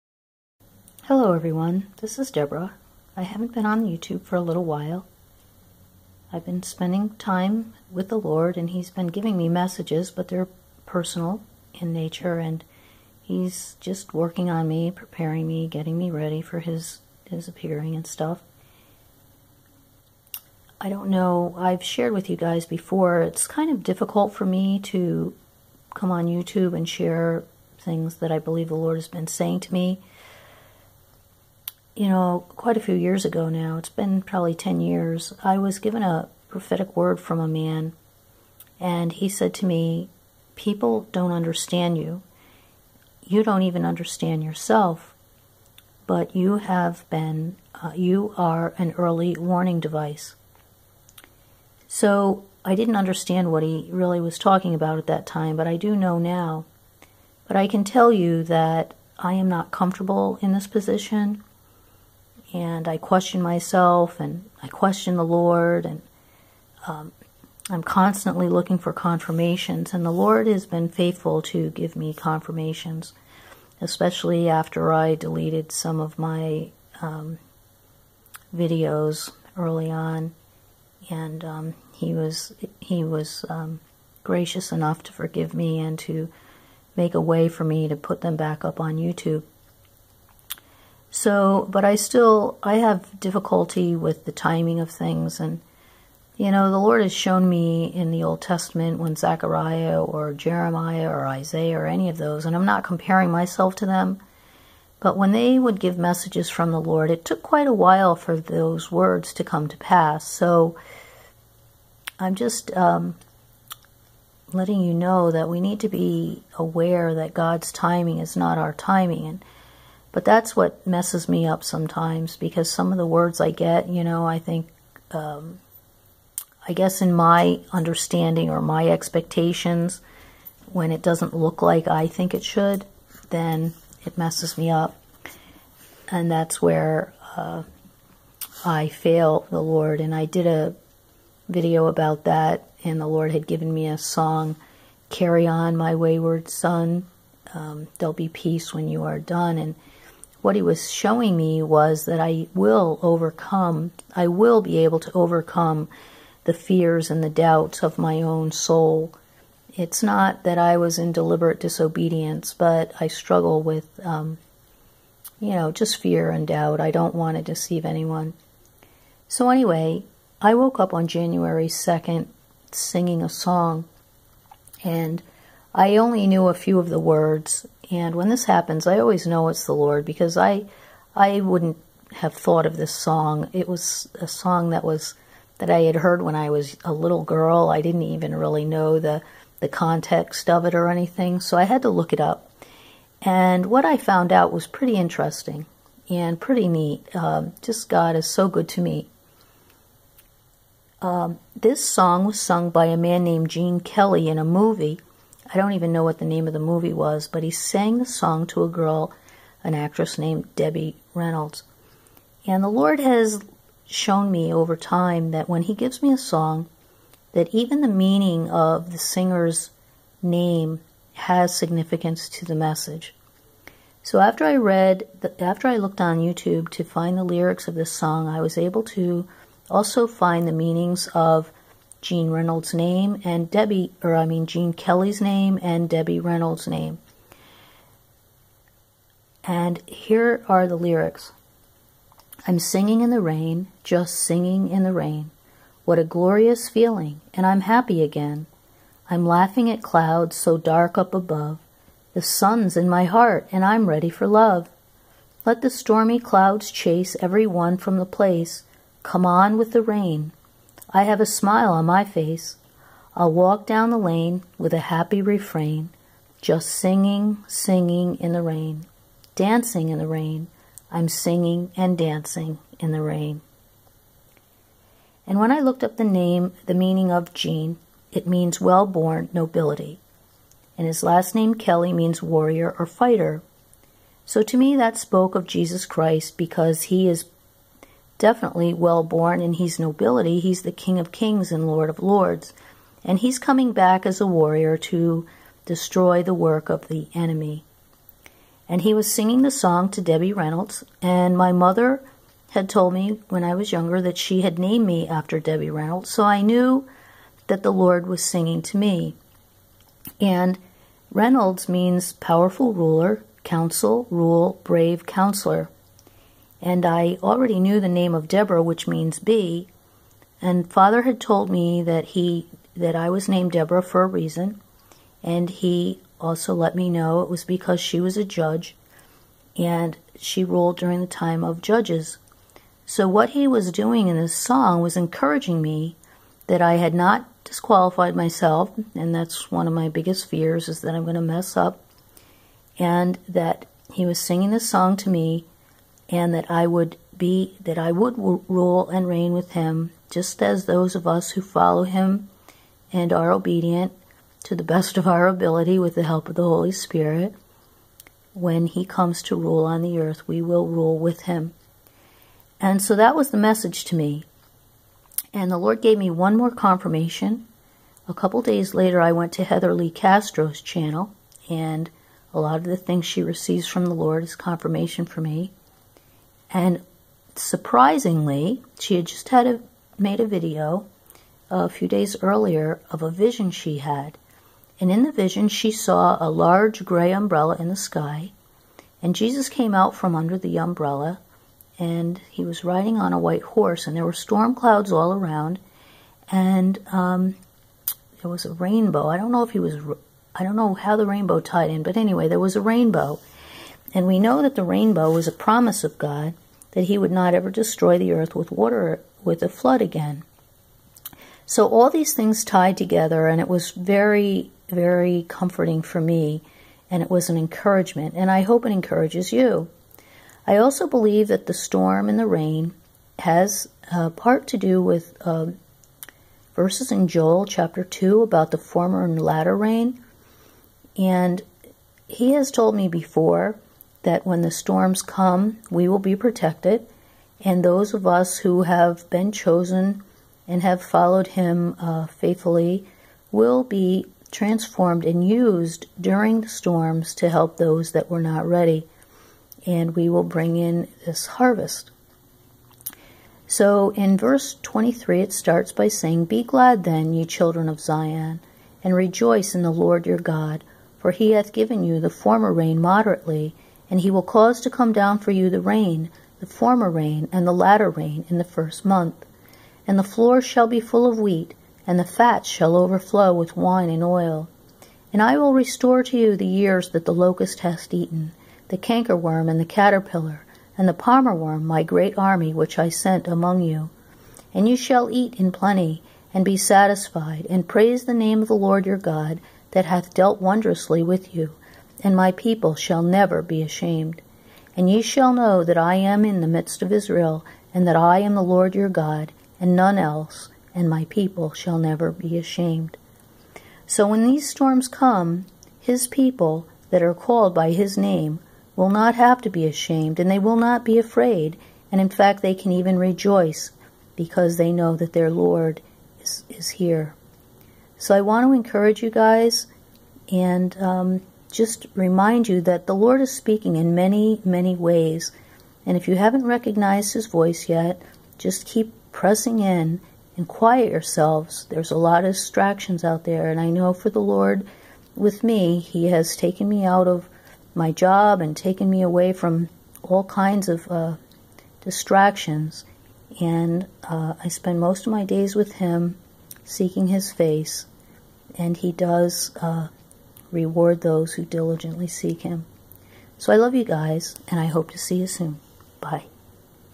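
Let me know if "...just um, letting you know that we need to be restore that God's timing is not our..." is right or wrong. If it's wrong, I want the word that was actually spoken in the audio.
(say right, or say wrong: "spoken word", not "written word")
wrong: "aware", not "restore".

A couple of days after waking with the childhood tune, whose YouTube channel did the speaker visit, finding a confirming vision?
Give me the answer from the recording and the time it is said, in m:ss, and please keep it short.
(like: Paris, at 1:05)
Heather Lee Castro, at 6:09.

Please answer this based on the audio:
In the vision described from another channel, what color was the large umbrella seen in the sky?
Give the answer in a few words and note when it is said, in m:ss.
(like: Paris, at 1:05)
Gray, at 6:26.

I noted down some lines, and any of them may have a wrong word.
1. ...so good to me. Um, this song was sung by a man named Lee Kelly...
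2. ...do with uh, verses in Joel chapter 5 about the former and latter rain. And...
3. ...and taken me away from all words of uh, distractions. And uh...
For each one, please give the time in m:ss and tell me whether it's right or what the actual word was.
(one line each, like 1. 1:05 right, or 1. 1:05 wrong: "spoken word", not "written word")
1. 3:18 wrong: "Gene", not "Lee"
2. 7:04 wrong: "2", not "5"
3. 8:58 wrong: "kinds", not "words".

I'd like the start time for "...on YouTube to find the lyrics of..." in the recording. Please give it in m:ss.
3:46.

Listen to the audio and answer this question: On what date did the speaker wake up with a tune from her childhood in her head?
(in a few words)
January 2nd.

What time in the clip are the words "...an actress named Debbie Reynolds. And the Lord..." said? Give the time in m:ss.
3:29.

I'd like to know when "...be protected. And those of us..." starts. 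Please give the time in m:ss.
7:15.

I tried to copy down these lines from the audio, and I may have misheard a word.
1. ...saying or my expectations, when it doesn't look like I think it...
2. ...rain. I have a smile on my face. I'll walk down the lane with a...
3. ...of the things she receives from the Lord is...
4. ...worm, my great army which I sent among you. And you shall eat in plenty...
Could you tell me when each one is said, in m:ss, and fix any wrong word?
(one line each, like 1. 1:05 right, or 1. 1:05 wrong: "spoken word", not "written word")
1. 2:07 wrong: "understanding", not "saying"
2. 4:19 right
3. 6:12 right
4. 8:01 right.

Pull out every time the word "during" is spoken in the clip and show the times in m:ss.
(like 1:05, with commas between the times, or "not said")
5:30, 7:25.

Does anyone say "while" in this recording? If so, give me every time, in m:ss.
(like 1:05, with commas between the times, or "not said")
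0:04, 1:47.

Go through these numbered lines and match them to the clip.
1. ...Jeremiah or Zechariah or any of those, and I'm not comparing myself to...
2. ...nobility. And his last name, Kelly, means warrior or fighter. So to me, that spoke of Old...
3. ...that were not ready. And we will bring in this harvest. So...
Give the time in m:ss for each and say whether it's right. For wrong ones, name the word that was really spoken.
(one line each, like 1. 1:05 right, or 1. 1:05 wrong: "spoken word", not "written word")
1. 1:40 wrong: "Isaiah", not "Zechariah"
2. 4:39 wrong: "Jesus", not "Old"
3. 7:27 right.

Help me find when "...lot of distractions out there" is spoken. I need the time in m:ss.
8:51.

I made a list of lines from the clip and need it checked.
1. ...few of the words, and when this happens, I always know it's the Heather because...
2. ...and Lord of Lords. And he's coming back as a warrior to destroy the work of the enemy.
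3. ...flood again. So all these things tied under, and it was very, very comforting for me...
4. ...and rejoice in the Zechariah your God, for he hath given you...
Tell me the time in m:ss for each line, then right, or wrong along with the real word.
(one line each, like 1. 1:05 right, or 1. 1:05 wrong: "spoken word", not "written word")
1. 2:56 wrong: "Lord", not "Heather"
2. 4:51 right
3. 6:49 wrong: "together", not "under"
4. 7:38 wrong: "Lord", not "Zechariah".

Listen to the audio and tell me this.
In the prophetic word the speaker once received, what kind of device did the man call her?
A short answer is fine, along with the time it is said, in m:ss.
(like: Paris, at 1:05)
An early warning device, at 0:48.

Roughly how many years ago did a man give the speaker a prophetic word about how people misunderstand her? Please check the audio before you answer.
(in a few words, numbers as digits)
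10 years.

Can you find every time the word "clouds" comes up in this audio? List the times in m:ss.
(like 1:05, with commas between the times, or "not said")
4:09, 4:16, 6:34.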